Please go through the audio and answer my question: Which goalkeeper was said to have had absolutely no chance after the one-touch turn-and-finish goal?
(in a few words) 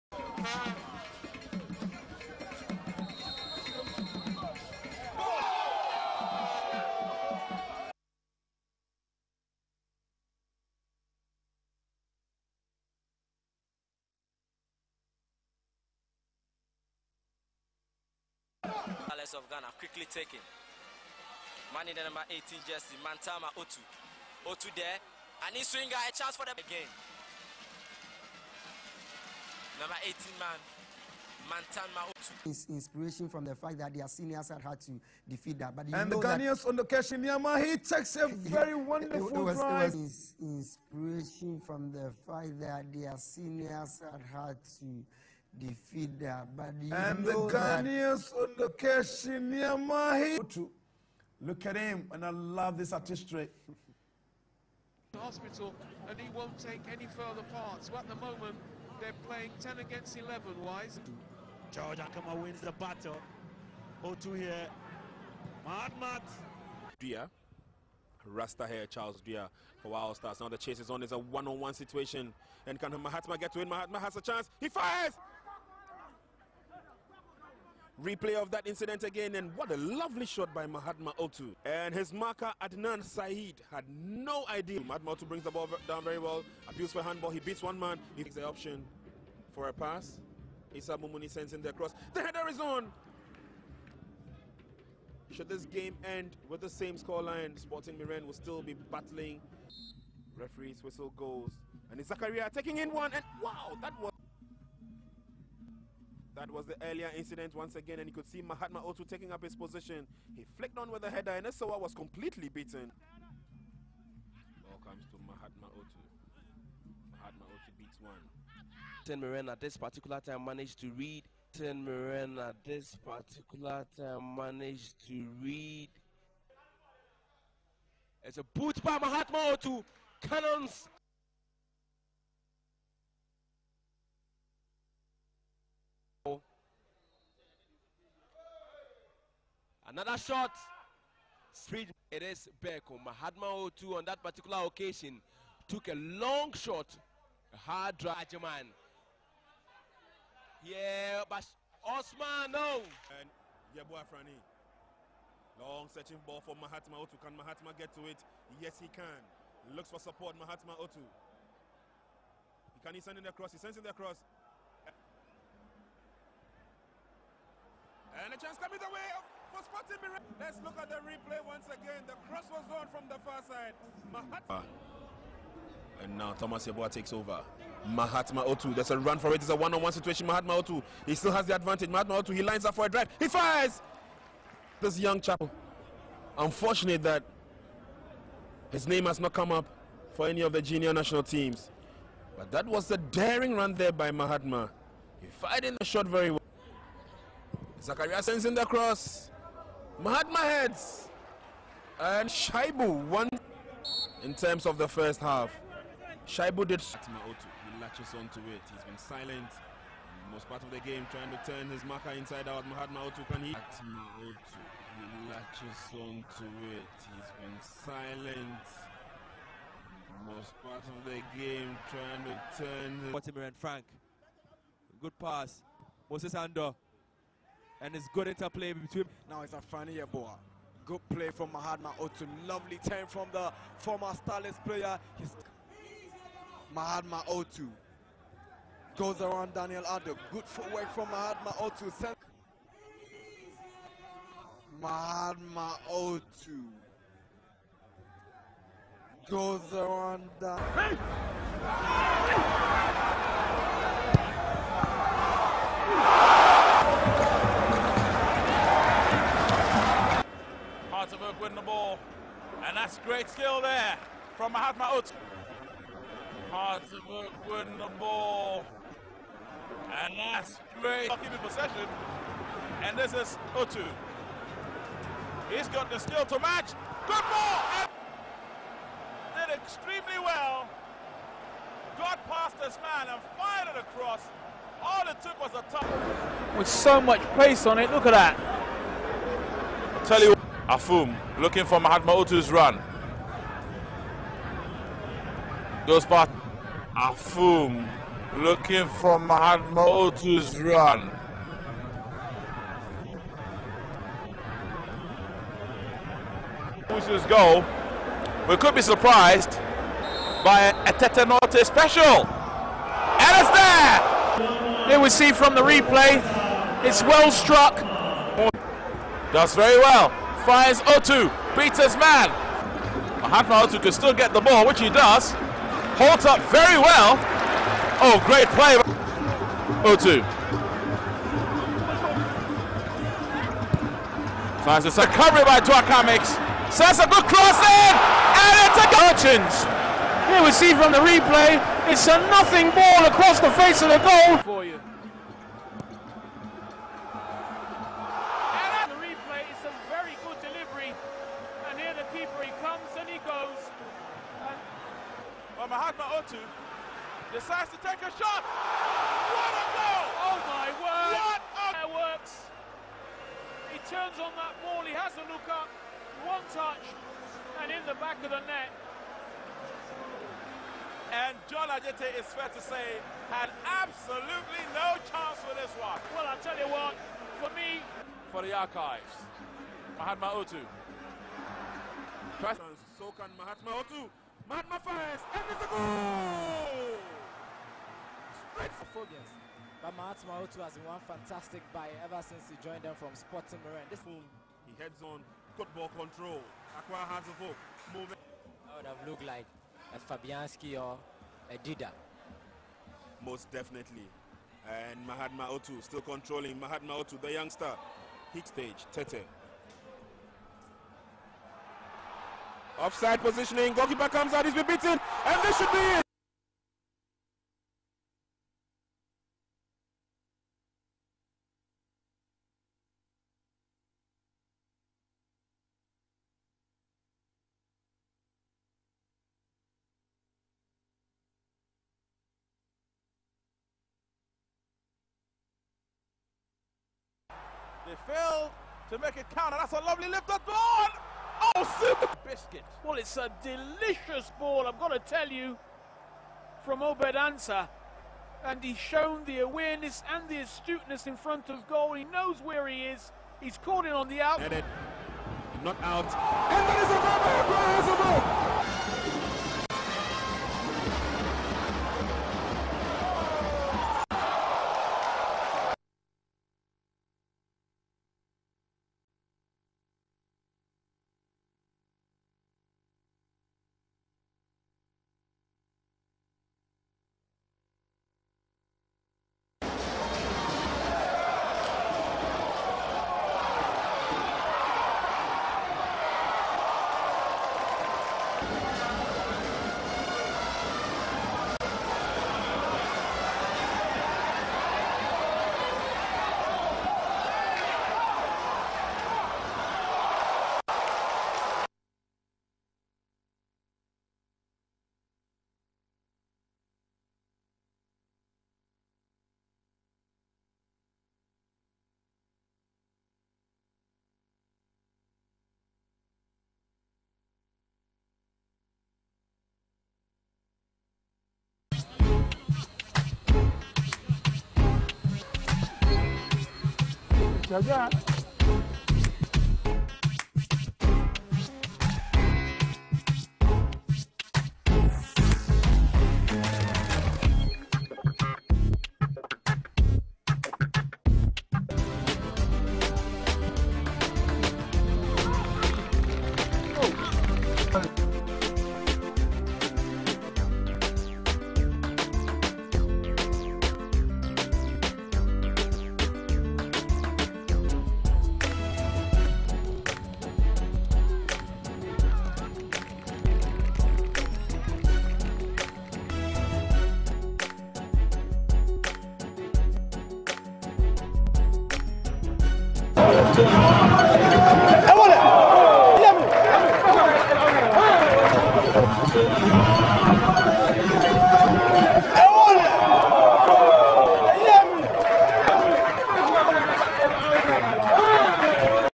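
John Ajete.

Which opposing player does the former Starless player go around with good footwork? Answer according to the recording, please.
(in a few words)
Daniel Addo.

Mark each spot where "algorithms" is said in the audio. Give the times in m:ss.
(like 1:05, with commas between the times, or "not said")
not said.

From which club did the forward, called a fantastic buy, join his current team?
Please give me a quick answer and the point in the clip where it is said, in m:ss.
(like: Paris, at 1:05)
Sporting Marin, at 6:33.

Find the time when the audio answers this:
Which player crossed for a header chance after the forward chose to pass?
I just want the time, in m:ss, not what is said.
1:30.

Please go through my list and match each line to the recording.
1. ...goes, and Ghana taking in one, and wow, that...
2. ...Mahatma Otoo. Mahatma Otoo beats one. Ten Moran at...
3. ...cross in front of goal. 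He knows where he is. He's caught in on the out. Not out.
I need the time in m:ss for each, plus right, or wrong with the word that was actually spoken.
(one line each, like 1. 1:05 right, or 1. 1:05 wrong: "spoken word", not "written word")
1. 1:41 wrong: "Zakaria", not "Ghana"
2. 1:55 right
3. 7:30 wrong: "astuteness", not "cross".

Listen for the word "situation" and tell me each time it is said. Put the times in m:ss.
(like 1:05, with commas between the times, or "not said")
1:11, 2:59.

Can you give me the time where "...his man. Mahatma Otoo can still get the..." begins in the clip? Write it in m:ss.
5:21.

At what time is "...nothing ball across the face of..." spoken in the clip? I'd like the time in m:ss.
5:42.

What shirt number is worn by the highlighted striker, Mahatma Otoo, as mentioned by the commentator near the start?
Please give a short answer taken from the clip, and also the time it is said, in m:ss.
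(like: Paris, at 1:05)
18, at 0:22.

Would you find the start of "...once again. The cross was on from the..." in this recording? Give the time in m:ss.
2:51.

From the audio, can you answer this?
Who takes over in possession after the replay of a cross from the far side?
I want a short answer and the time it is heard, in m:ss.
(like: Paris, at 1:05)
Thomas Yeboah, at 2:56.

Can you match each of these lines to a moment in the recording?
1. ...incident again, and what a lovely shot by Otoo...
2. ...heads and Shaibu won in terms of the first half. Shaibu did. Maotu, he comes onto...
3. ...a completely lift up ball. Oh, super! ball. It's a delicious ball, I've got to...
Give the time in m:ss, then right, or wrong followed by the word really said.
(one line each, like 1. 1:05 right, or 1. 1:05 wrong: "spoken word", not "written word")
1. 1:18 wrong: "Mahatma", not "Otoo"
2. 3:20 wrong: "latches", not "comes"
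3. 7:19 wrong: "lovely", not "completely".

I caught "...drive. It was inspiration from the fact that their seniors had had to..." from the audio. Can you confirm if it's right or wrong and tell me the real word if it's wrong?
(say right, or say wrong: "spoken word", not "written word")
right.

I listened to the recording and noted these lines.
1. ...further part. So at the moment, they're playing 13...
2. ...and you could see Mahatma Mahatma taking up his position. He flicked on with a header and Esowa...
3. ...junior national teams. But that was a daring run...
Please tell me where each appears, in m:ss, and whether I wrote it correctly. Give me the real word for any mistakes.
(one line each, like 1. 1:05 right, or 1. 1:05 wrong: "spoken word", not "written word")
1. 0:57 wrong: "10", not "13"
2. 1:47 wrong: "Otoo", not "Mahatma"
3. 3:10 right.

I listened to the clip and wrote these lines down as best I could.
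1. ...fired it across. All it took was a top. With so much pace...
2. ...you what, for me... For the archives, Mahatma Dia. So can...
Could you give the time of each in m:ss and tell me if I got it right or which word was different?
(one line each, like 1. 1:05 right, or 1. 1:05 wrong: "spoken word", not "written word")
1. 4:43 right
2. 6:16 wrong: "Otoo", not "Dia".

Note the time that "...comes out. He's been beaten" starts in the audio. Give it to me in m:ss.
6:54.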